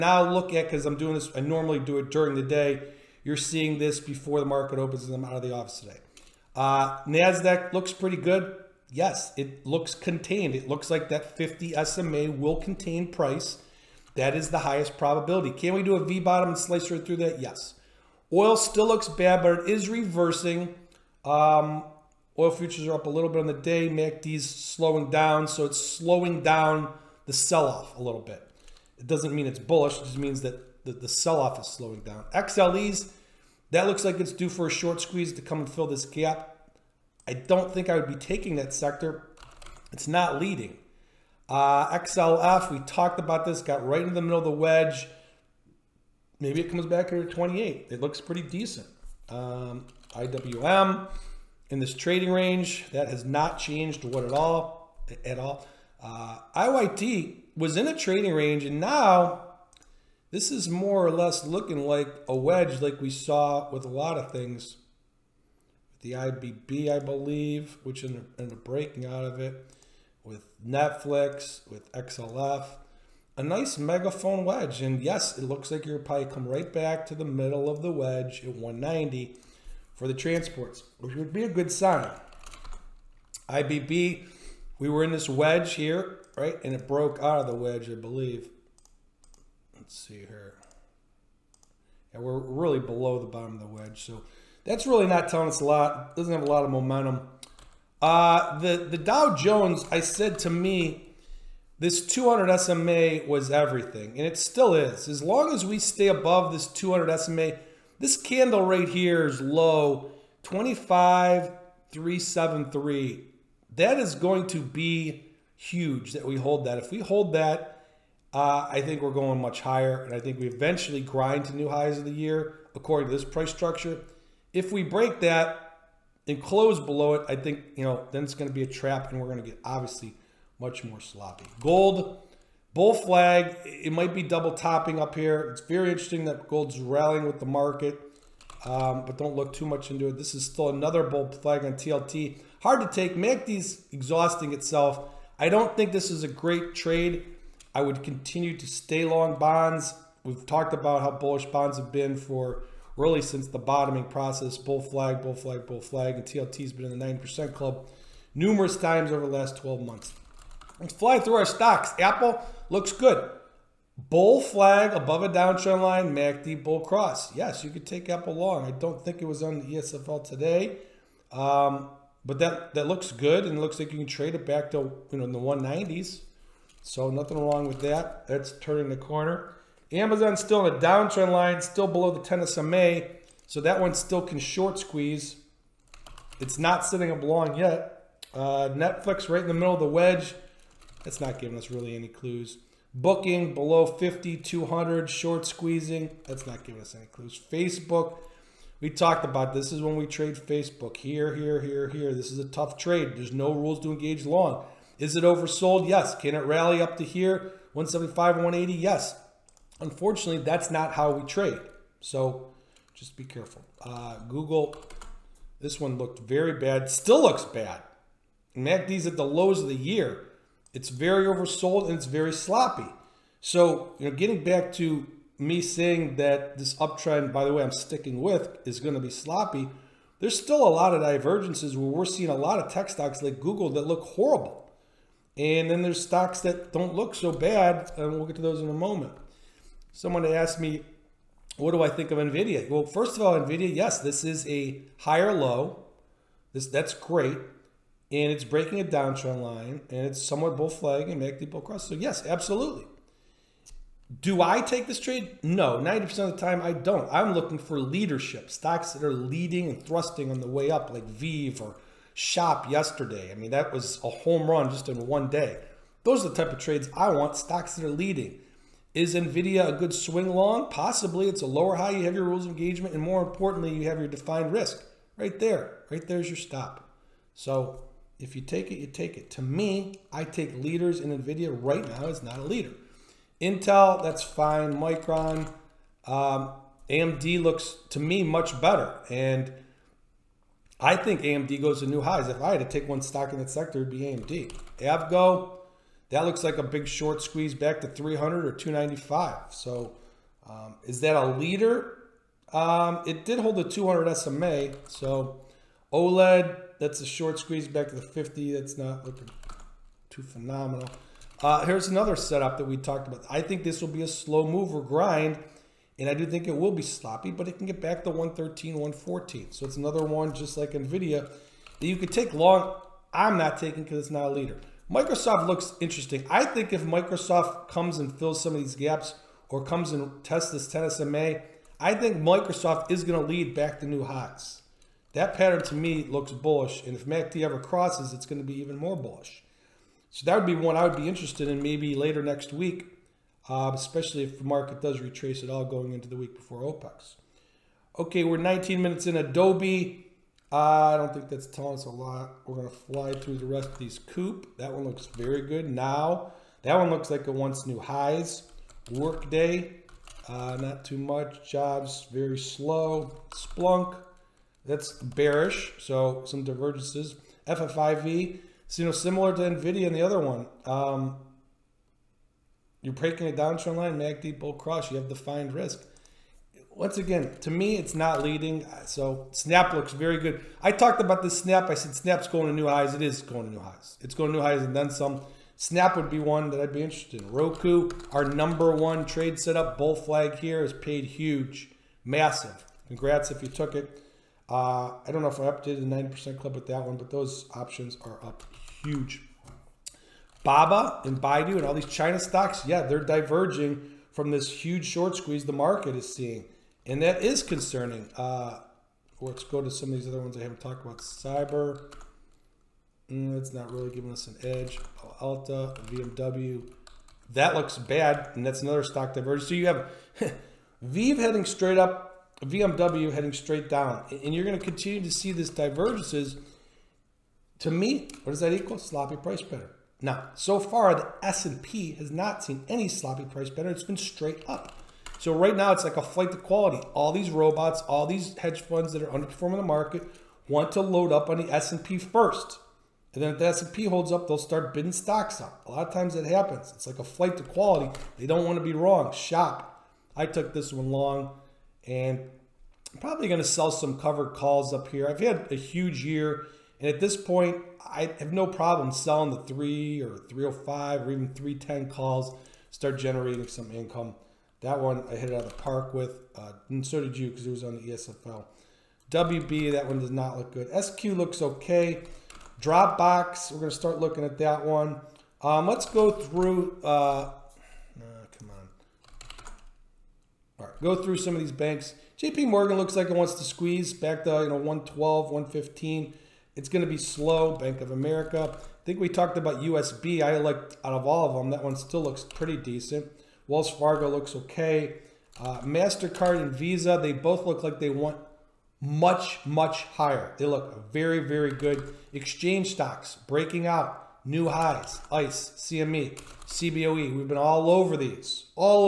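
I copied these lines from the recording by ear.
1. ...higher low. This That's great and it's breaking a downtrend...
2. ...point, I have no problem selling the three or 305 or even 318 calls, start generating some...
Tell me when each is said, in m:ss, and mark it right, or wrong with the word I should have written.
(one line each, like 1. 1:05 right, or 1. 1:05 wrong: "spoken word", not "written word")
1. 4:04 right
2. 7:37 wrong: "310", not "318".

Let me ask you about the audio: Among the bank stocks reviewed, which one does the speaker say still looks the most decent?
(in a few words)
USB.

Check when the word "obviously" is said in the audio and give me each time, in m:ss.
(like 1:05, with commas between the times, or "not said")
2:09.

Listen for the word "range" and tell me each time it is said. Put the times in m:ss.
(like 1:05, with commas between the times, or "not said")
0:52, 0:58.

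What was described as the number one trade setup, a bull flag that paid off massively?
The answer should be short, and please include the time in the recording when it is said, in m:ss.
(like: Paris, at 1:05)
Roku, at 6:27.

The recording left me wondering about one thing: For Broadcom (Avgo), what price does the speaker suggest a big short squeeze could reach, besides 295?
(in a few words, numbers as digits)
300.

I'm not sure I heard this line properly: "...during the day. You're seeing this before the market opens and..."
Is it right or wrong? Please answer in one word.
right.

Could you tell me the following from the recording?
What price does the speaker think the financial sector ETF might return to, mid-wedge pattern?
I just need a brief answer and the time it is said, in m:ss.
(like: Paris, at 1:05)
28, at 0:47.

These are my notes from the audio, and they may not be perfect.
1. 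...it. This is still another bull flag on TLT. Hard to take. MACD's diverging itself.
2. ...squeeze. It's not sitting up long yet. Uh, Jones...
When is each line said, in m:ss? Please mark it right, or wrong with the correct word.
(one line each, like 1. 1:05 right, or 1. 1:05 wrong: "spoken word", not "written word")
1. 2:20 wrong: "exhausting", not "diverging"
2. 3:04 wrong: "Netflix", not "Jones".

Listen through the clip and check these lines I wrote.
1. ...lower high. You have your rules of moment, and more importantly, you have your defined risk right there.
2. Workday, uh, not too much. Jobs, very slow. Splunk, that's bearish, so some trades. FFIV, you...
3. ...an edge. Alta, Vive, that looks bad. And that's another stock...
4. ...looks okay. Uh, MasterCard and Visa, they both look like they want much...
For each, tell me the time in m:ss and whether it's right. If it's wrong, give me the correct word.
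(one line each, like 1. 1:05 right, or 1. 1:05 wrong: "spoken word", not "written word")
1. 4:31 wrong: "engagement", not "moment"
2. 5:58 wrong: "divergences", not "trades"
3. 6:54 wrong: "VMW", not "Vive"
4. 8:14 right.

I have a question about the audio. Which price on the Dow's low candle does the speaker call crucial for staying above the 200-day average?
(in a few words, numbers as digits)
25,373.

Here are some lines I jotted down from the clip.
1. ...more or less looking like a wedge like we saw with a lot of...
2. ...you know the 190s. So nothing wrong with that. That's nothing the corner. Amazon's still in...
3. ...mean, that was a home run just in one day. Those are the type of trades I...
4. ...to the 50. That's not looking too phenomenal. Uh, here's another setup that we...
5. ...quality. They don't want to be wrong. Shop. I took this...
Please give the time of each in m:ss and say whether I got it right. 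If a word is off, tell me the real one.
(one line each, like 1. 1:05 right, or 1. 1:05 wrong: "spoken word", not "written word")
1. 1:00 right
2. 2:55 wrong: "turning", not "nothing"
3. 4:23 right
4. 5:07 right
5. 7:27 right.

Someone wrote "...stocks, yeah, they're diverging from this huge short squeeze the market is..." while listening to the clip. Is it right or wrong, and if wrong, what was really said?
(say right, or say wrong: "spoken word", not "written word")
right.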